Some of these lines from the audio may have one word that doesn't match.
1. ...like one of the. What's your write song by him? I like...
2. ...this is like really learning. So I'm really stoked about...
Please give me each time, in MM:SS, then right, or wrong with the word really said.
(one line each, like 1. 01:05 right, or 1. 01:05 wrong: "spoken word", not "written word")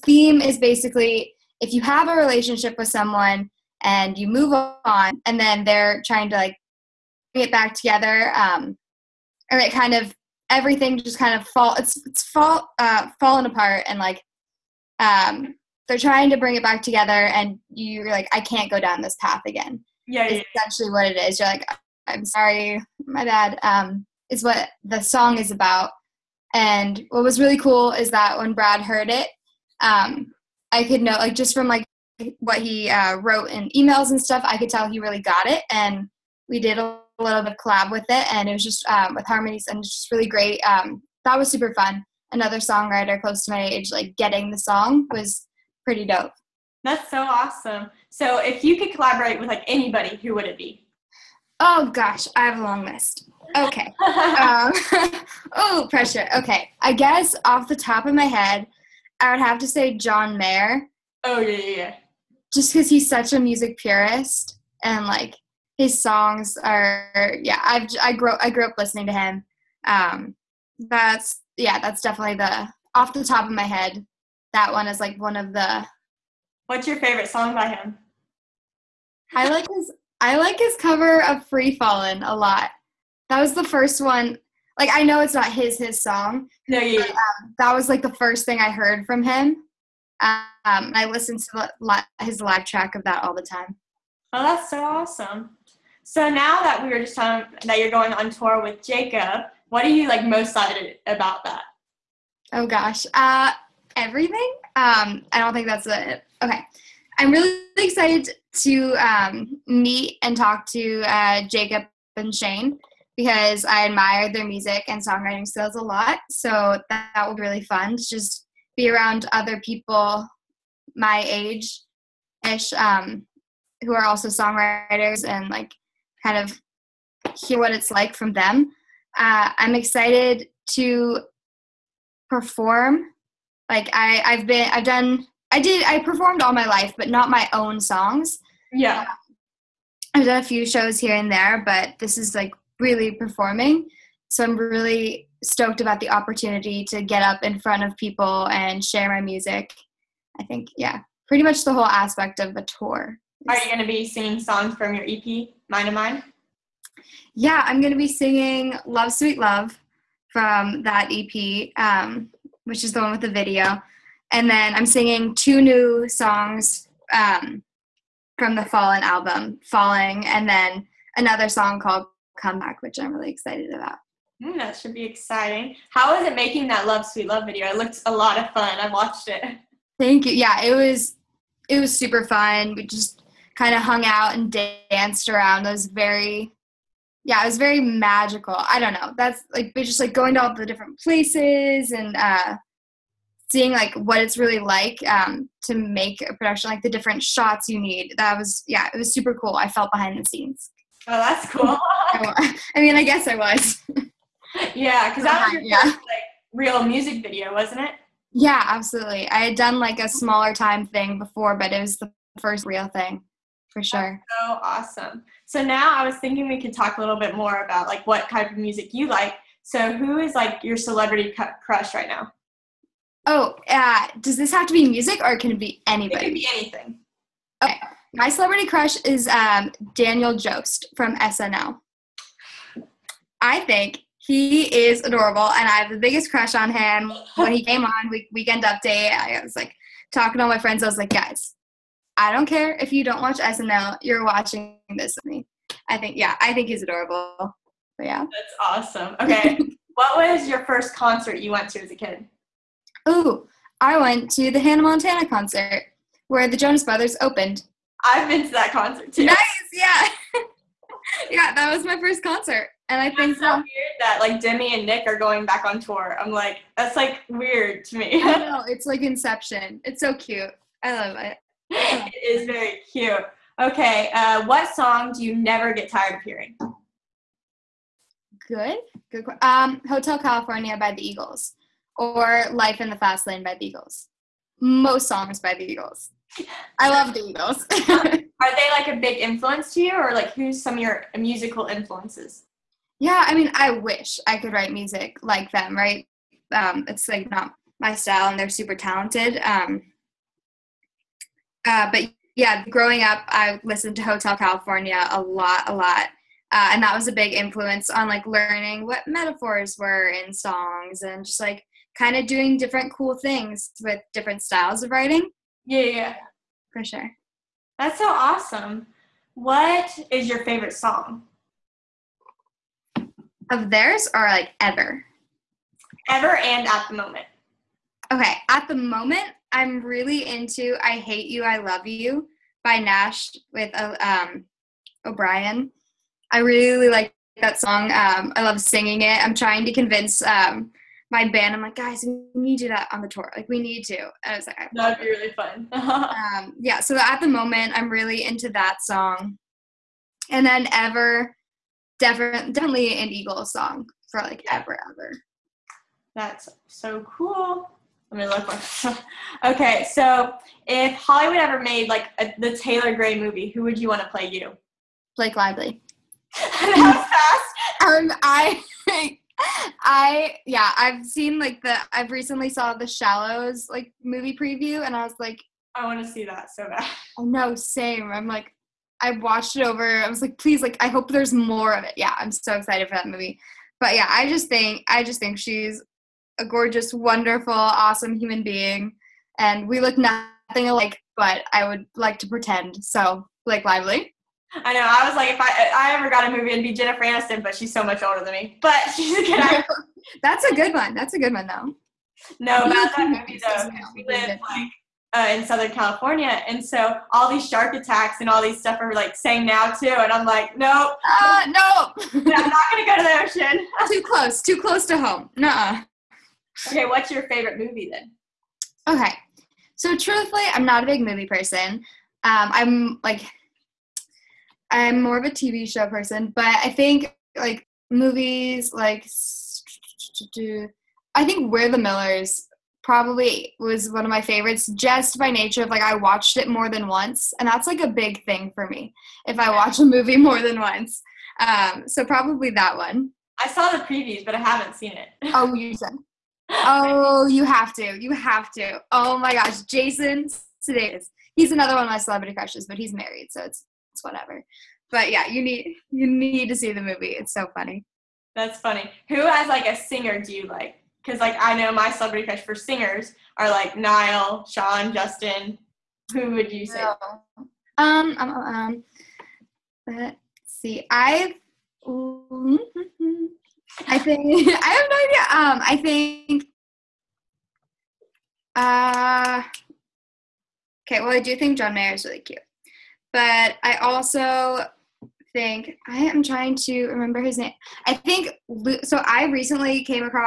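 1. 01:15 wrong: "favorite", not "write"
2. 02:21 wrong: "performing", not "learning".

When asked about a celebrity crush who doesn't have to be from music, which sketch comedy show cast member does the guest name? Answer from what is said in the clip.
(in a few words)
Daniel Jost.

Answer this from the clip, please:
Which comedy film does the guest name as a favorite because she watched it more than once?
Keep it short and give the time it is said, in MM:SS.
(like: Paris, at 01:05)
We're the Millers, at 07:11.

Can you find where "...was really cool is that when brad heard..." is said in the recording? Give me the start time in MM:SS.
00:27.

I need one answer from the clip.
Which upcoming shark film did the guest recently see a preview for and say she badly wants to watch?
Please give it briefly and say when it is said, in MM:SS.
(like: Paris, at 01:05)
The Shallows, at 06:12.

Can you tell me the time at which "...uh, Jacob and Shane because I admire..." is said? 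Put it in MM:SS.
01:51.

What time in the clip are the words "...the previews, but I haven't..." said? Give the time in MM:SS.
07:23.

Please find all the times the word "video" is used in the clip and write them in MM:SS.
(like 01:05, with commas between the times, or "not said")
02:43, 02:57, 03:27.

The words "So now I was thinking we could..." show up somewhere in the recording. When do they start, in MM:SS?
03:35.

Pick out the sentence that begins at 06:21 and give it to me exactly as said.
Yeah, I'm so excited for that movie.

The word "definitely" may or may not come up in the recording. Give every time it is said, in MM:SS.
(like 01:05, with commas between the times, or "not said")
01:12, 05:51.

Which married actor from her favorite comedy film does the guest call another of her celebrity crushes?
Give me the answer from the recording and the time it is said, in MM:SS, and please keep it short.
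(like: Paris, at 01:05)
Jason Sudeikis, at 07:29.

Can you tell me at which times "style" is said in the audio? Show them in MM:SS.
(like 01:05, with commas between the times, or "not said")
04:57, 05:14.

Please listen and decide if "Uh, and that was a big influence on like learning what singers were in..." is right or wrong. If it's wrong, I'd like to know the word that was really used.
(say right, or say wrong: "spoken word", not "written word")
wrong: "metaphors", not "singers".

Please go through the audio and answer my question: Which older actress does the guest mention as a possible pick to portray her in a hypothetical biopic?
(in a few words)
Jennifer Aniston.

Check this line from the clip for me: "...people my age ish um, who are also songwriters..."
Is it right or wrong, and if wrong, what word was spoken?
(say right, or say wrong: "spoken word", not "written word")
right.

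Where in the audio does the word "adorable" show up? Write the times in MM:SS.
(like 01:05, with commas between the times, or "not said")
03:55, 04:06.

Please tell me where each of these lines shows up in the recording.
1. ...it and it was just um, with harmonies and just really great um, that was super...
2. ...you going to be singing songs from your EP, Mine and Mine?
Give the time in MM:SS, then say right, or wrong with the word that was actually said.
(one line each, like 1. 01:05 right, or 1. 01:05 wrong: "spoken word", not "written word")
1. 00:38 right
2. 02:33 right.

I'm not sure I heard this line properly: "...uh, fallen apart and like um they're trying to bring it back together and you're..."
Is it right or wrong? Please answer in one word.
right.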